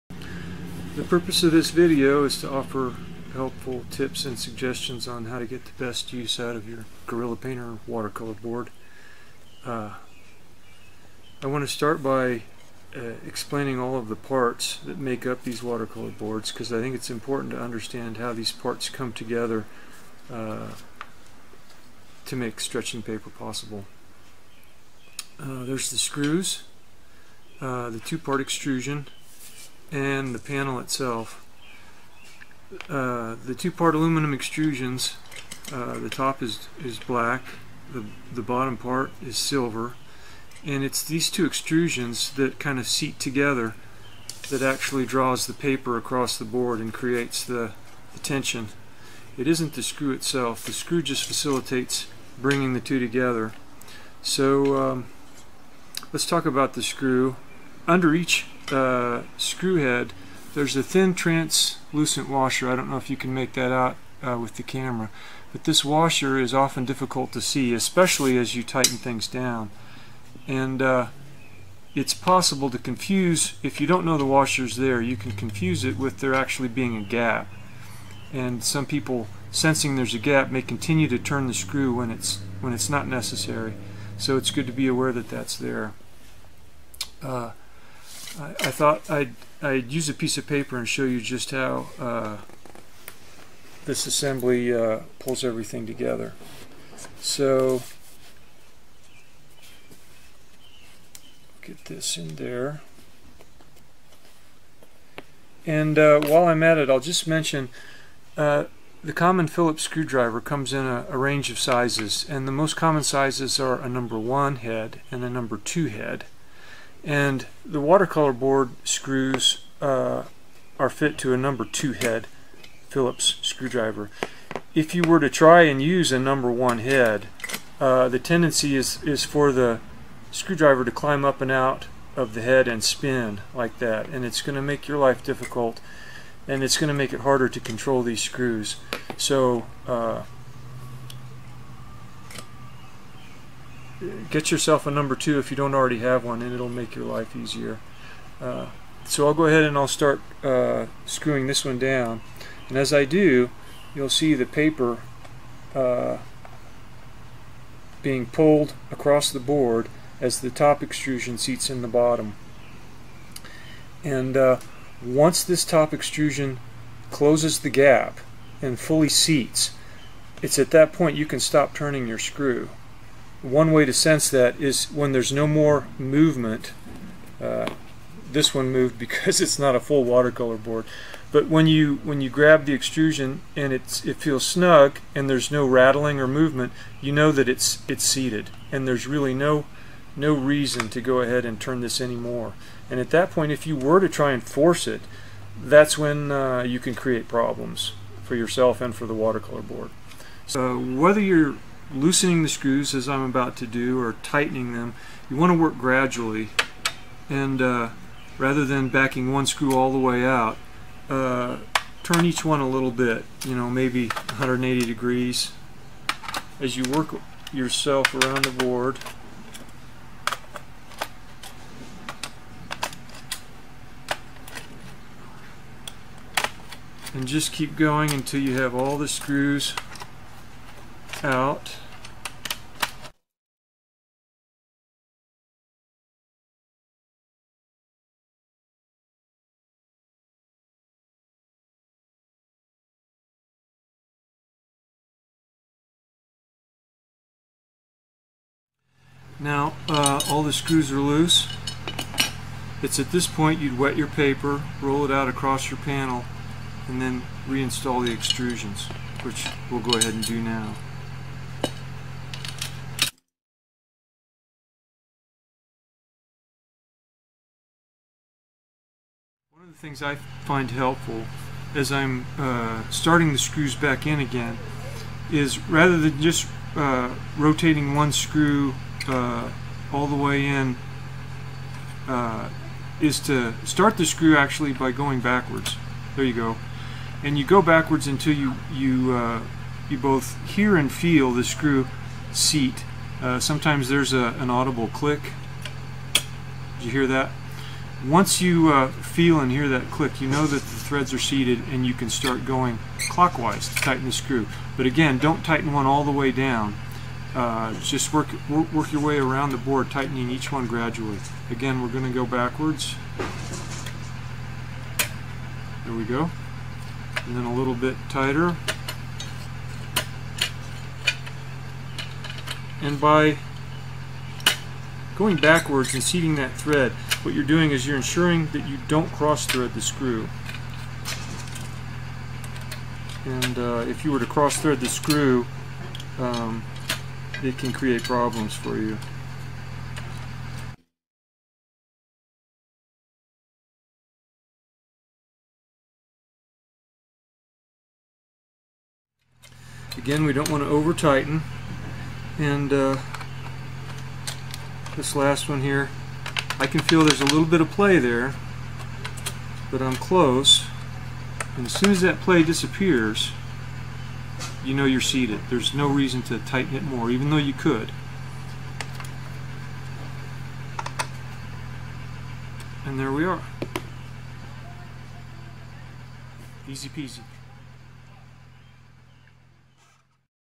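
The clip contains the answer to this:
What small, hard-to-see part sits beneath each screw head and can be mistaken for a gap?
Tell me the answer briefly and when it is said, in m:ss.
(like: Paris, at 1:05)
Translucent washer, at 1:01.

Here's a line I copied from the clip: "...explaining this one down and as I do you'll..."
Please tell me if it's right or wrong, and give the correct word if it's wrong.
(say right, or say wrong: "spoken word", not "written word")
wrong: "screwing", not "explaining".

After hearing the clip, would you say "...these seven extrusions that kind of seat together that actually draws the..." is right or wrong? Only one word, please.
wrong.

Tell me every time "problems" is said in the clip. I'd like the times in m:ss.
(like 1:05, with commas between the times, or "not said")
3:17, 5:38.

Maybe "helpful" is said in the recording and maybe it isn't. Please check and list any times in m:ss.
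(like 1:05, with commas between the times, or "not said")
0:03, 4:30.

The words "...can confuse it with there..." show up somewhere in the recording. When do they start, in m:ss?
1:15.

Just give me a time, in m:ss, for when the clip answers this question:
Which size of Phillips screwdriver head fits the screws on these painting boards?
2:01.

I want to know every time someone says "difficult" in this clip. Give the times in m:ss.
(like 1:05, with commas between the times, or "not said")
1:06, 2:15.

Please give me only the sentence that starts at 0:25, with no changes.
Uh, there's the screws, uh, the two-part extrusion, and the panel itself.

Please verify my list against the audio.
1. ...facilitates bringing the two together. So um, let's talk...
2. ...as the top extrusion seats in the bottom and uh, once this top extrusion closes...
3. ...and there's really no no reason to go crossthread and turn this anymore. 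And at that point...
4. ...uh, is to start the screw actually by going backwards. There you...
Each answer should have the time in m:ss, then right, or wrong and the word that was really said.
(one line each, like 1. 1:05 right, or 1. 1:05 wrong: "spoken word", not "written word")
1. 0:51 right
2. 2:40 right
3. 3:08 wrong: "ahead", not "crossthread"
4. 4:42 right.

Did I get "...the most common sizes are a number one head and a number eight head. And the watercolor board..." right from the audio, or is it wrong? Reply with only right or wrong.
wrong.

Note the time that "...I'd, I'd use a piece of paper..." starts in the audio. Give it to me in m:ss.
1:29.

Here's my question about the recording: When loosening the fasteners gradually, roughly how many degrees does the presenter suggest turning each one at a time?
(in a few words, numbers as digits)
180 degrees.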